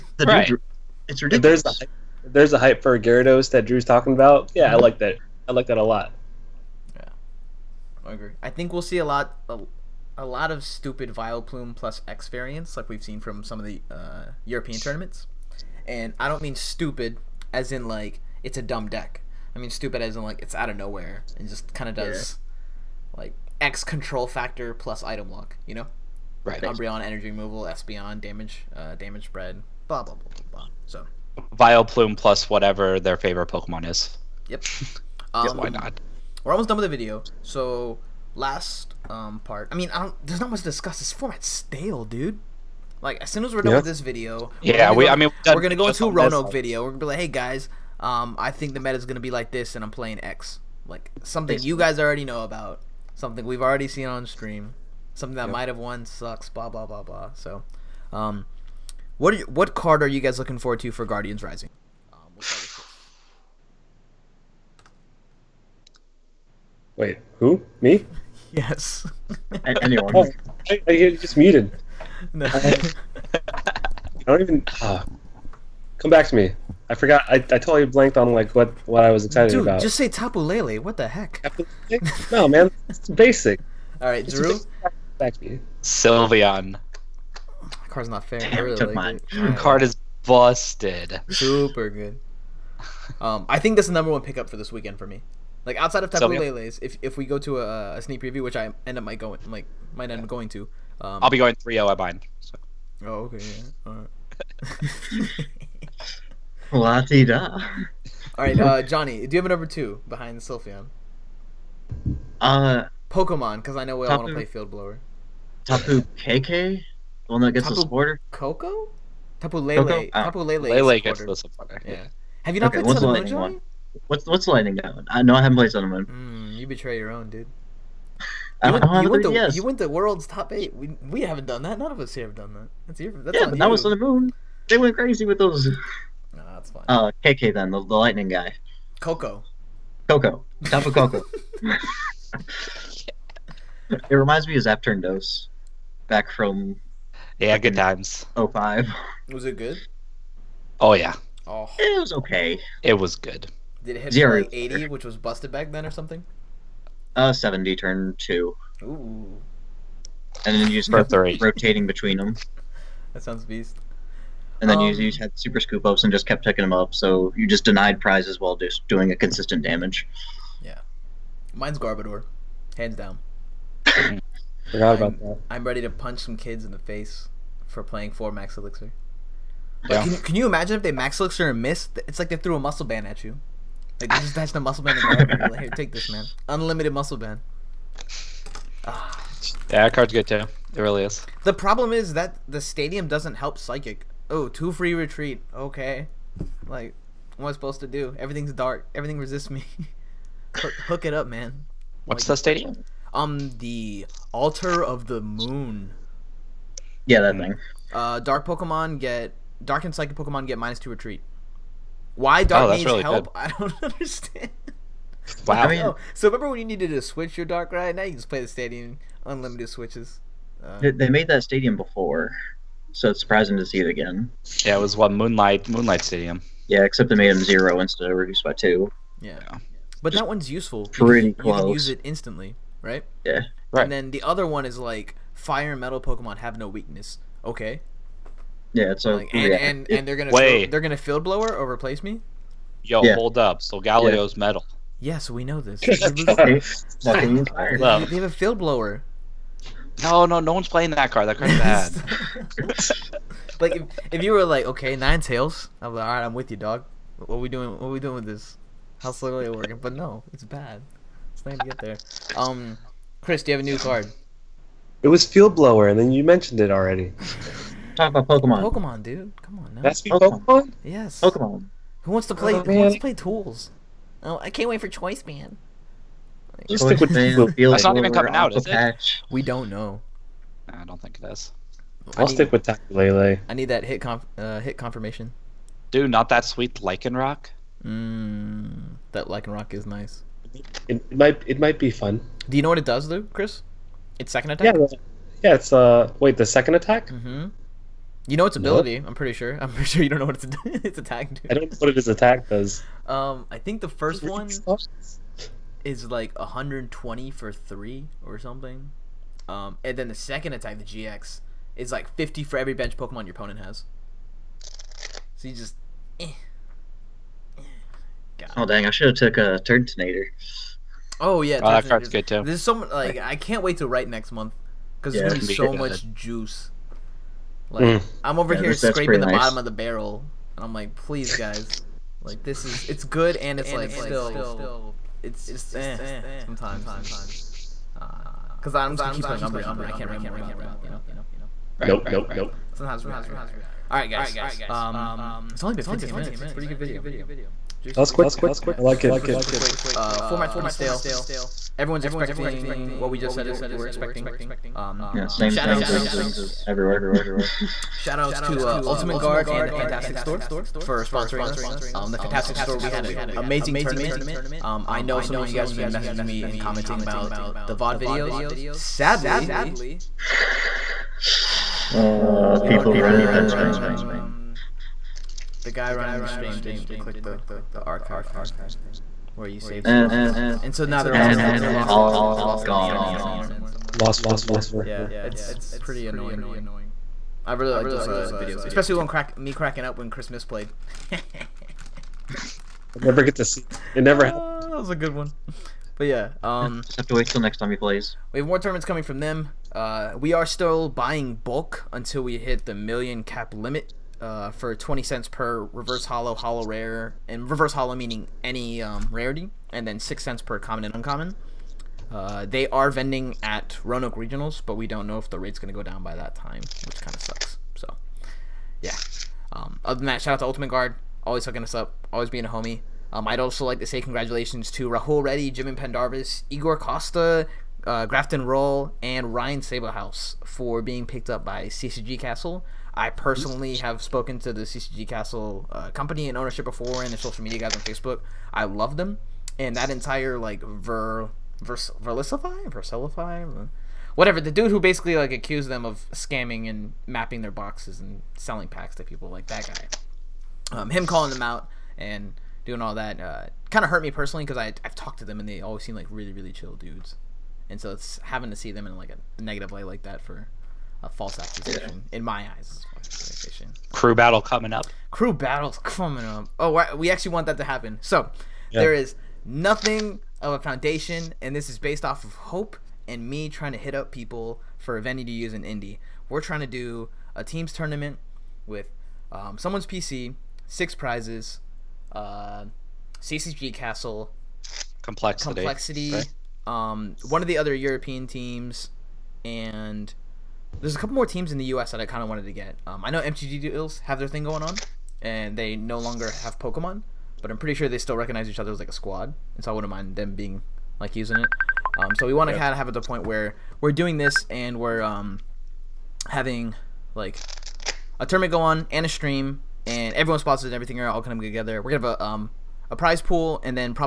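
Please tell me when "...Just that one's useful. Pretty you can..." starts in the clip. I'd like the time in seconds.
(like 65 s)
230 s.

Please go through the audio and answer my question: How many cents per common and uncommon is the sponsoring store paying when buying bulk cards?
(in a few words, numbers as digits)
6 cents.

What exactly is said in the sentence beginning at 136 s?
Oh, Koko then, the, the lightning guy.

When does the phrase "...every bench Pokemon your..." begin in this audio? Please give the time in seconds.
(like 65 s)
312 s.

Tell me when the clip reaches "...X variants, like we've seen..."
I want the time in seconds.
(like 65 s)
12 s.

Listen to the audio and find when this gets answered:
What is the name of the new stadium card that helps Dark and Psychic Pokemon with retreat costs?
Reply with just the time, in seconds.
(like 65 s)
204 s.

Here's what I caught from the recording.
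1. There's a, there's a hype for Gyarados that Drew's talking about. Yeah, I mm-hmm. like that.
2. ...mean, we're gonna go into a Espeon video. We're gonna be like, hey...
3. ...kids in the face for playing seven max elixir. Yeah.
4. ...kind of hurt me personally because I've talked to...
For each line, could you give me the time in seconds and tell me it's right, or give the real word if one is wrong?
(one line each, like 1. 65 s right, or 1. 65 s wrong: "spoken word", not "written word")
1. 1 s right
2. 45 s wrong: "Roanoke", not "Espeon"
3. 176 s wrong: "four", not "seven"
4. 453 s right.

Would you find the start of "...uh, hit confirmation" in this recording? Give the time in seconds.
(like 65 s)
284 s.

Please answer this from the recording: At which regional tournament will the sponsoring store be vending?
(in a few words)
Roanoke Regionals.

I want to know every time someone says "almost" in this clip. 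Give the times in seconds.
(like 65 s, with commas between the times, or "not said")
36 s.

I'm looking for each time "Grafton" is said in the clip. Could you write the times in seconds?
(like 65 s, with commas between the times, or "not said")
428 s.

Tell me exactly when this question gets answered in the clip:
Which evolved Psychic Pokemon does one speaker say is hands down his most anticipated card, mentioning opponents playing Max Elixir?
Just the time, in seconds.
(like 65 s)
171 s.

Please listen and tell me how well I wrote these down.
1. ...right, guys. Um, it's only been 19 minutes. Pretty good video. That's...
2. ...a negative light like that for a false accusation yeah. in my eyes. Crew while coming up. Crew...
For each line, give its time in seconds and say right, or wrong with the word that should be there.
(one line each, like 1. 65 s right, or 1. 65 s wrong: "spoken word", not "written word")
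1. 343 s wrong: "15", not "19"
2. 459 s wrong: "battle", not "while".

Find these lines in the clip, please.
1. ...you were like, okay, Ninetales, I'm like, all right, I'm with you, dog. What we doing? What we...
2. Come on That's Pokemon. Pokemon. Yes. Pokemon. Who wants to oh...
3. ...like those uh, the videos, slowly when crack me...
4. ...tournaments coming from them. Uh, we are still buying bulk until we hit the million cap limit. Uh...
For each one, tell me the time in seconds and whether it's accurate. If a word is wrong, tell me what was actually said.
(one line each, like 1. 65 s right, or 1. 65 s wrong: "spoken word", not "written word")
1. 254 s right
2. 269 s right
3. 387 s wrong: "especially", not "slowly"
4. 398 s right.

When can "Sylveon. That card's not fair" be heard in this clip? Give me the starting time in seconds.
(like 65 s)
85 s.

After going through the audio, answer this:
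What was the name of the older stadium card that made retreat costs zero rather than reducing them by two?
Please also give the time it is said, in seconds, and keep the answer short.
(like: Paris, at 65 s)
Moonlight Stadium, at 225 s.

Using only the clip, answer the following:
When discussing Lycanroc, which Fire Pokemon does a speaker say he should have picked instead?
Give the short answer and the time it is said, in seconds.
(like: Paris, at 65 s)
Turtonator, at 319 s.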